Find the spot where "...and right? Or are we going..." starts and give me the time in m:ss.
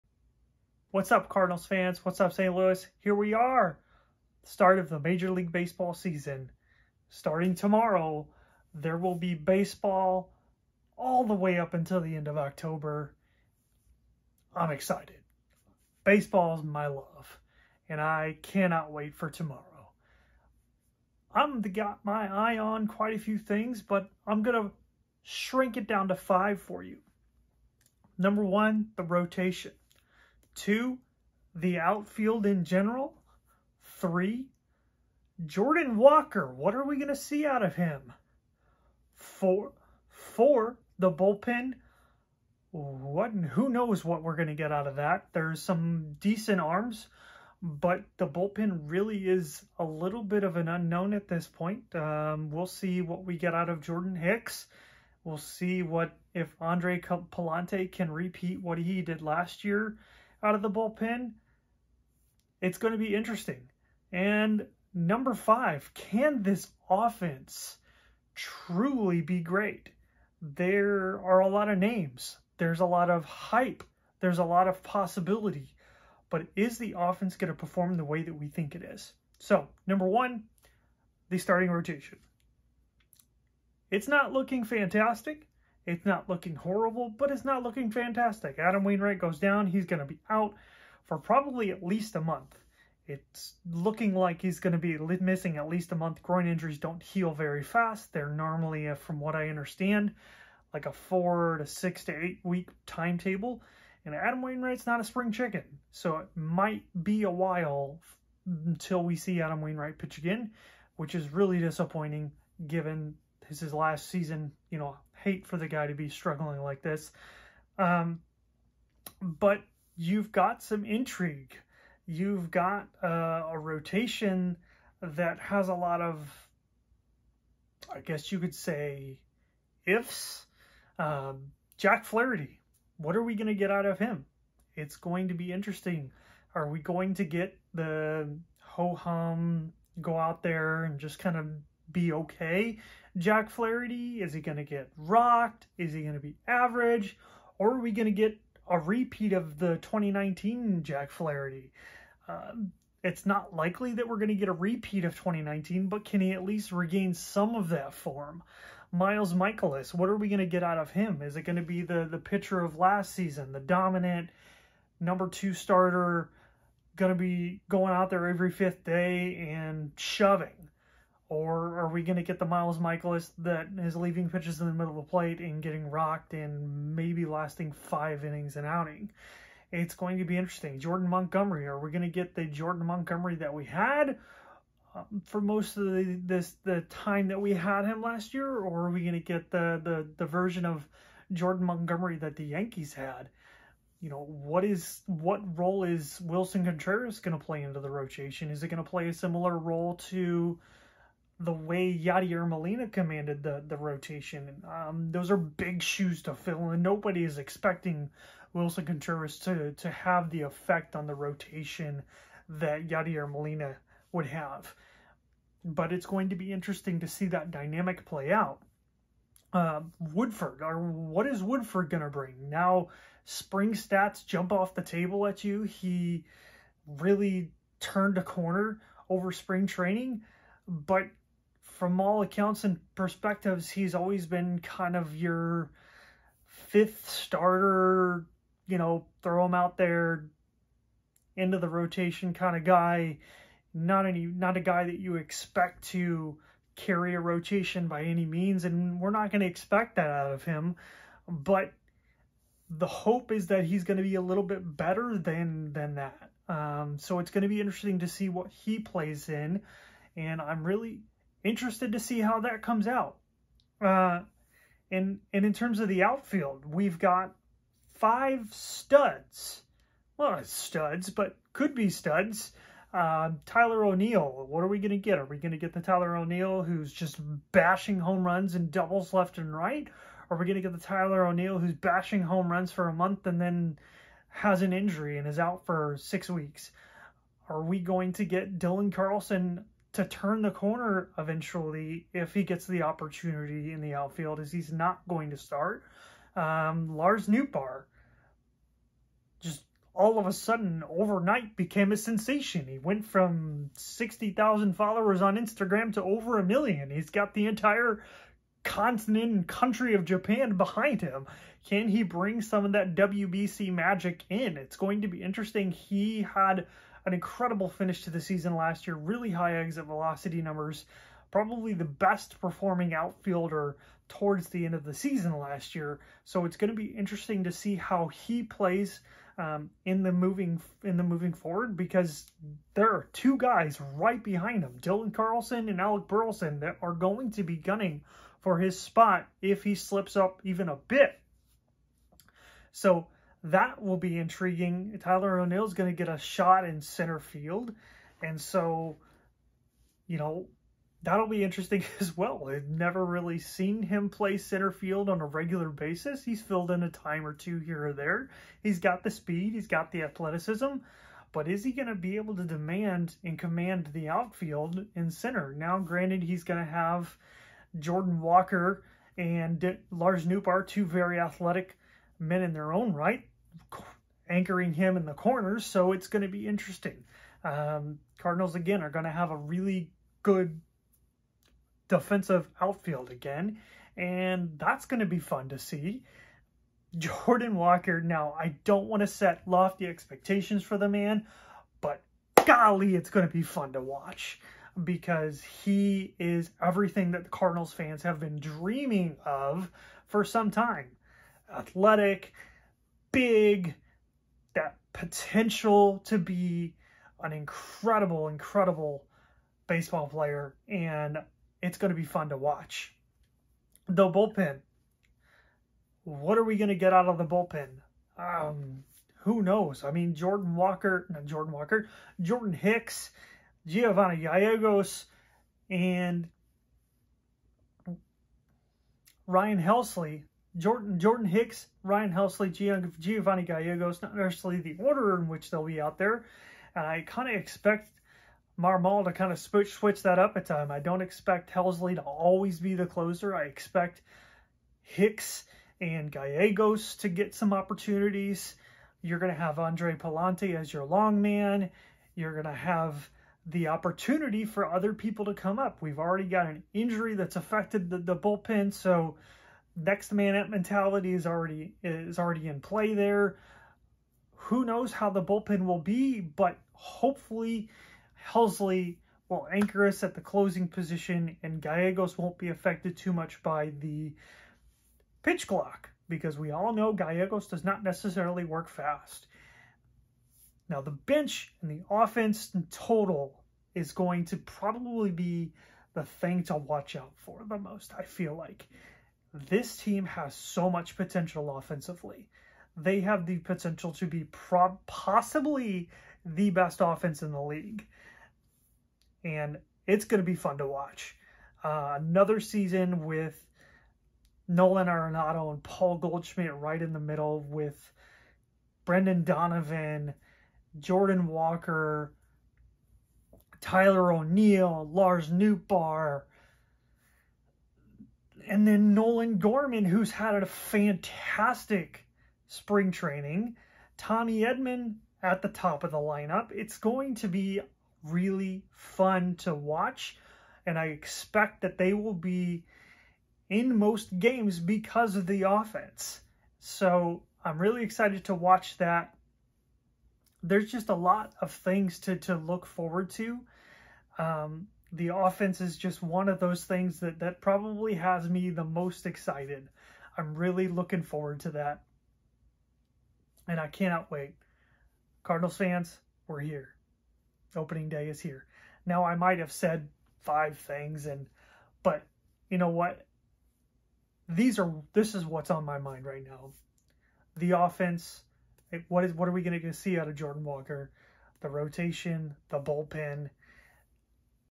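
4:39.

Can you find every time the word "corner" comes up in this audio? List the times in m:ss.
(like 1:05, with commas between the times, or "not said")
3:48, 4:50, 6:15.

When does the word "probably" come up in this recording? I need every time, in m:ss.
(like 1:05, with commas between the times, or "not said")
1:31, 5:21, 8:04, 9:07.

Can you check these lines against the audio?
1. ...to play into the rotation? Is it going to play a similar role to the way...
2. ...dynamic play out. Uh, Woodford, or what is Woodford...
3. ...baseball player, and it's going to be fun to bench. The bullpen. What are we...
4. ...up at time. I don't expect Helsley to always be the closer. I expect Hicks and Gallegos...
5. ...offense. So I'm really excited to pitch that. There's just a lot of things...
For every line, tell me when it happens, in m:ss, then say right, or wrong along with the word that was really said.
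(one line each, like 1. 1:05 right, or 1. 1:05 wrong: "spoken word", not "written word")
1. 3:17 right
2. 3:37 right
3. 6:49 wrong: "watch", not "bench"
4. 7:20 right
5. 8:55 wrong: "watch", not "pitch".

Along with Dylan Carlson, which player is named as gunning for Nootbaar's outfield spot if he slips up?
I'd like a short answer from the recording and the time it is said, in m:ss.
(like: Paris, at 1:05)
Alec Burleson, at 5:35.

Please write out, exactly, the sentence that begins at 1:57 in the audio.
Um, but you've got some intrigue.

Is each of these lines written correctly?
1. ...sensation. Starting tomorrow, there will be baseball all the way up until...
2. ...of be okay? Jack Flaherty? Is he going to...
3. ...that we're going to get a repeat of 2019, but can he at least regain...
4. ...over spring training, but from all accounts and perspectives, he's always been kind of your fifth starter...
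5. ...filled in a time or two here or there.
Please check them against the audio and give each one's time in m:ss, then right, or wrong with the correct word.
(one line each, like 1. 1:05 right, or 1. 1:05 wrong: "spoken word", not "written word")
1. 0:05 wrong: "season", not "sensation"
2. 2:21 right
3. 2:33 right
4. 3:49 right
5. 5:56 right.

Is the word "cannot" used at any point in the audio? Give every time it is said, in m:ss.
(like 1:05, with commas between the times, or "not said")
0:18, 9:13.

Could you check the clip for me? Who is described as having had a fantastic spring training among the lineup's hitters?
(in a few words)
Nolan Gorman.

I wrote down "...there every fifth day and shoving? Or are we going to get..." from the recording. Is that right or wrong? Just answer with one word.
right.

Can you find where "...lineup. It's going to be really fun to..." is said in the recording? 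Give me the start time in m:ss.
8:45.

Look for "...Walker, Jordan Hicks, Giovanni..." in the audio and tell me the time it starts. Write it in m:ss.
7:01.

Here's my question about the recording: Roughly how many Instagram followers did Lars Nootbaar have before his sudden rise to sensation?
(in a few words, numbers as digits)
60,000.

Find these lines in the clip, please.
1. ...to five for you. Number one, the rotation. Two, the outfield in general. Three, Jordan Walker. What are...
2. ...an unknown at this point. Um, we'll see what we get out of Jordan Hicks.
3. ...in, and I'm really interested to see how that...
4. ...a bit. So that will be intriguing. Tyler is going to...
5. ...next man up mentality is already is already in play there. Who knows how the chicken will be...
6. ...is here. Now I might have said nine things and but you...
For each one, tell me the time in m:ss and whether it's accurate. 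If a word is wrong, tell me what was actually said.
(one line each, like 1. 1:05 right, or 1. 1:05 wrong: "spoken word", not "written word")
1. 0:26 right
2. 0:50 right
3. 4:19 right
4. 5:40 right
5. 7:39 wrong: "bullpen", not "chicken"
6. 9:18 wrong: "five", not "nine".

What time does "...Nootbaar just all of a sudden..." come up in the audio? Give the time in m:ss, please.
4:57.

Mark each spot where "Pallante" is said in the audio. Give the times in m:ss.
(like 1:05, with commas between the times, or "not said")
0:56, 7:29.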